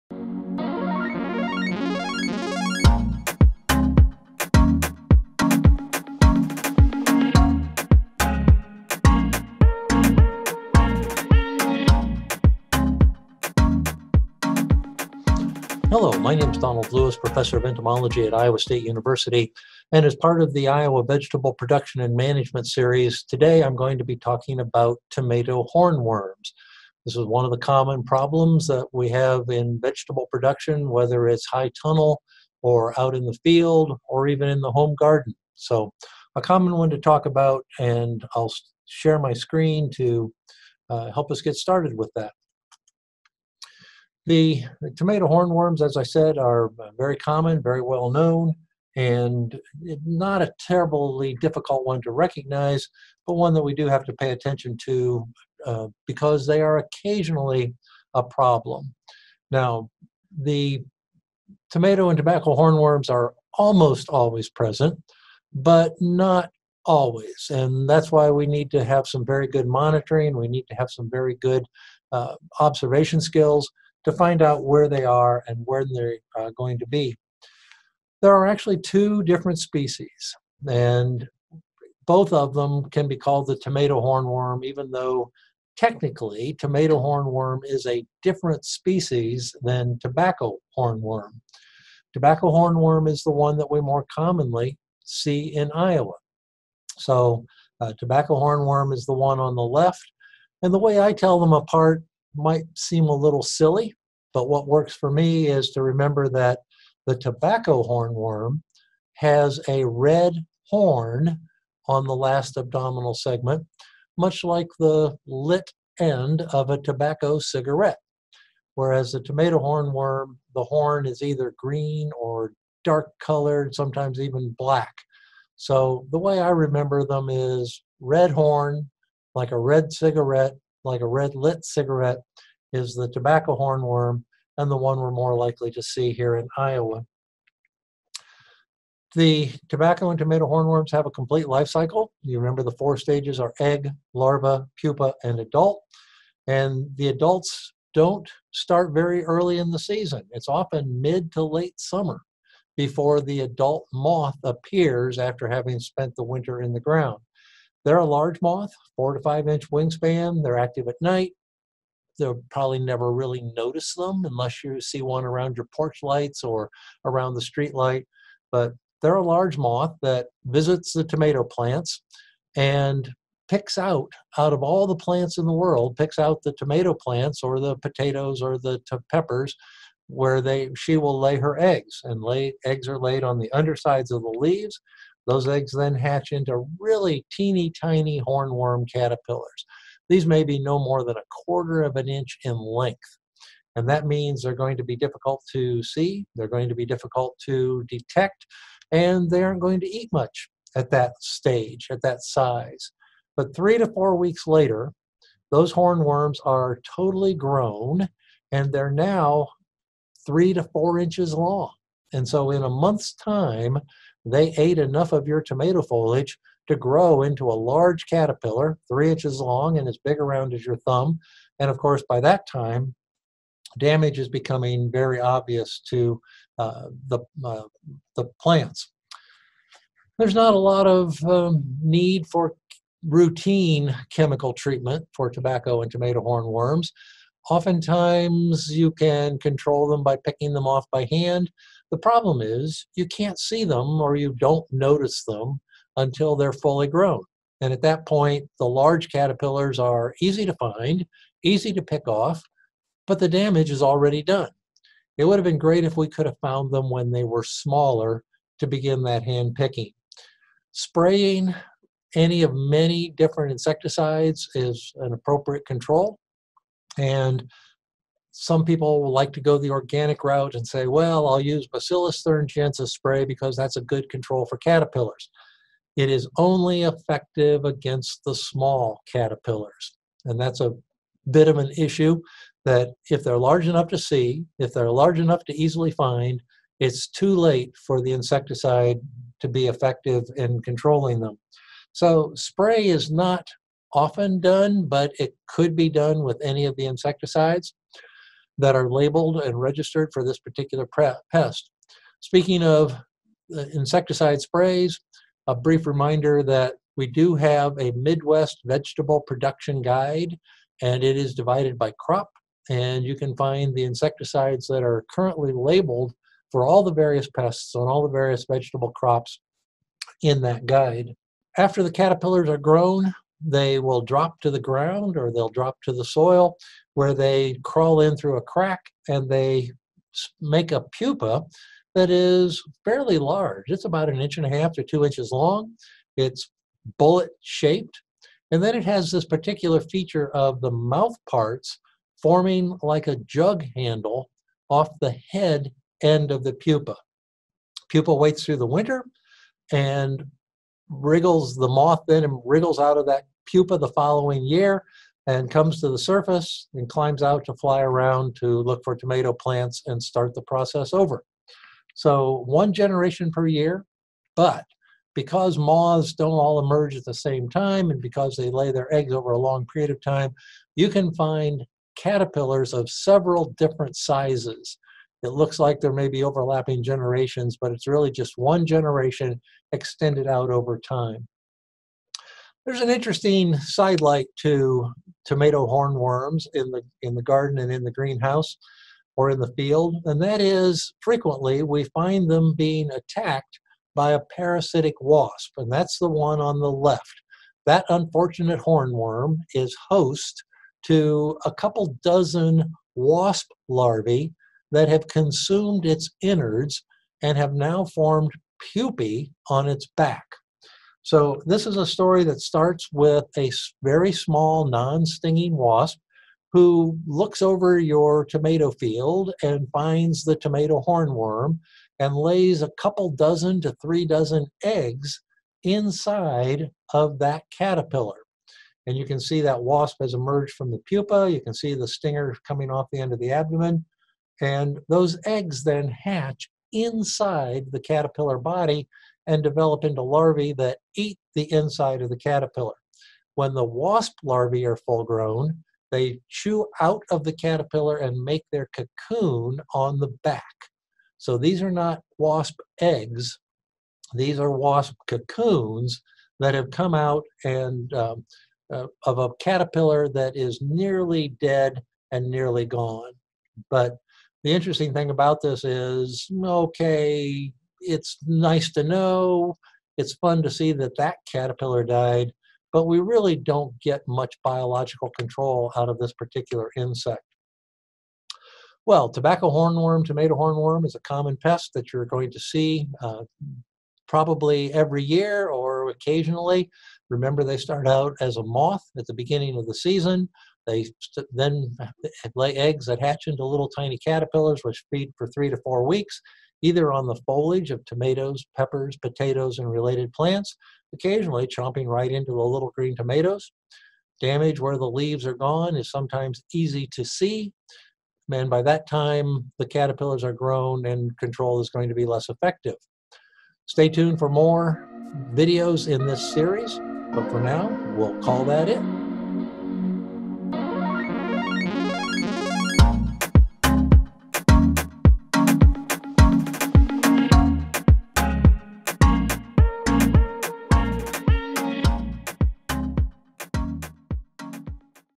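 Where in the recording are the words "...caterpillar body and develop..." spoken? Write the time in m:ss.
7:17.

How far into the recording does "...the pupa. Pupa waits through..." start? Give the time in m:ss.
5:46.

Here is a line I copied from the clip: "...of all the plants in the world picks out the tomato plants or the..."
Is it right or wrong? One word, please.
right.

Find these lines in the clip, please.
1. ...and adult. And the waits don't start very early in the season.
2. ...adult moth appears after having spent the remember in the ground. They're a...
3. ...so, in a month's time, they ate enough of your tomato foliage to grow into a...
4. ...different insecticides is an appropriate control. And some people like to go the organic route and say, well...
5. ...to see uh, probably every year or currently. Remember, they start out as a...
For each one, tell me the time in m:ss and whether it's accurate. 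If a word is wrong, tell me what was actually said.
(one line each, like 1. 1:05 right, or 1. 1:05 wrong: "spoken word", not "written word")
1. 2:25 wrong: "adults", not "waits"
2. 2:33 wrong: "winter", not "remember"
3. 3:32 right
4. 4:23 right
5. 8:02 wrong: "occasionally", not "currently".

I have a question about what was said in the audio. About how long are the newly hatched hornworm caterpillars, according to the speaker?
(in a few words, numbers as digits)
a quarter of an inch.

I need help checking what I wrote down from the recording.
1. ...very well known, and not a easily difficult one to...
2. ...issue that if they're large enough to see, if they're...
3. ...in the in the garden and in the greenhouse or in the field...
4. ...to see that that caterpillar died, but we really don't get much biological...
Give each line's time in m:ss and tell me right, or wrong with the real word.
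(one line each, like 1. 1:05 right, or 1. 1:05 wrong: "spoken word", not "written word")
1. 0:47 wrong: "terribly", not "easily"
2. 4:41 right
3. 6:26 right
4. 7:50 right.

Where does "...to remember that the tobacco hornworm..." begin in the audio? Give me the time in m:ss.
1:45.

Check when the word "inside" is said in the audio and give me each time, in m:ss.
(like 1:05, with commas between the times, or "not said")
7:05, 7:16, 7:21.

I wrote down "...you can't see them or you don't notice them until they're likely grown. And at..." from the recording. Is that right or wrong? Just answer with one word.
wrong.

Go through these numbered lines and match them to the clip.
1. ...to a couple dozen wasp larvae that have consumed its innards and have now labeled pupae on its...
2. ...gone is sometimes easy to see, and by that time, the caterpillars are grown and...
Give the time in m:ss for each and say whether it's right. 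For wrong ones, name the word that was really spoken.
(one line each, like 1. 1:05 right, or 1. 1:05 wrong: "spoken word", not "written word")
1. 6:40 wrong: "formed", not "labeled"
2. 8:25 right.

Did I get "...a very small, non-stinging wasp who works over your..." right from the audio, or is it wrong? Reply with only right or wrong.
wrong.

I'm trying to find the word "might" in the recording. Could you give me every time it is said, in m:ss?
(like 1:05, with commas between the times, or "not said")
1:42.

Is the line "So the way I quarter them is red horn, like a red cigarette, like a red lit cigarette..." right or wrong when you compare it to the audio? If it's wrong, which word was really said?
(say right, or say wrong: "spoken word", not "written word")
wrong: "remember", not "quarter".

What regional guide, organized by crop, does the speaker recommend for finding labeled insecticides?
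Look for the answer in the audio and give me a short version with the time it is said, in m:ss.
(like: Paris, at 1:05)
Midwest vegetable production guide, at 5:07.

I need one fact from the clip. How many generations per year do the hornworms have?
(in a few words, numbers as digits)
1.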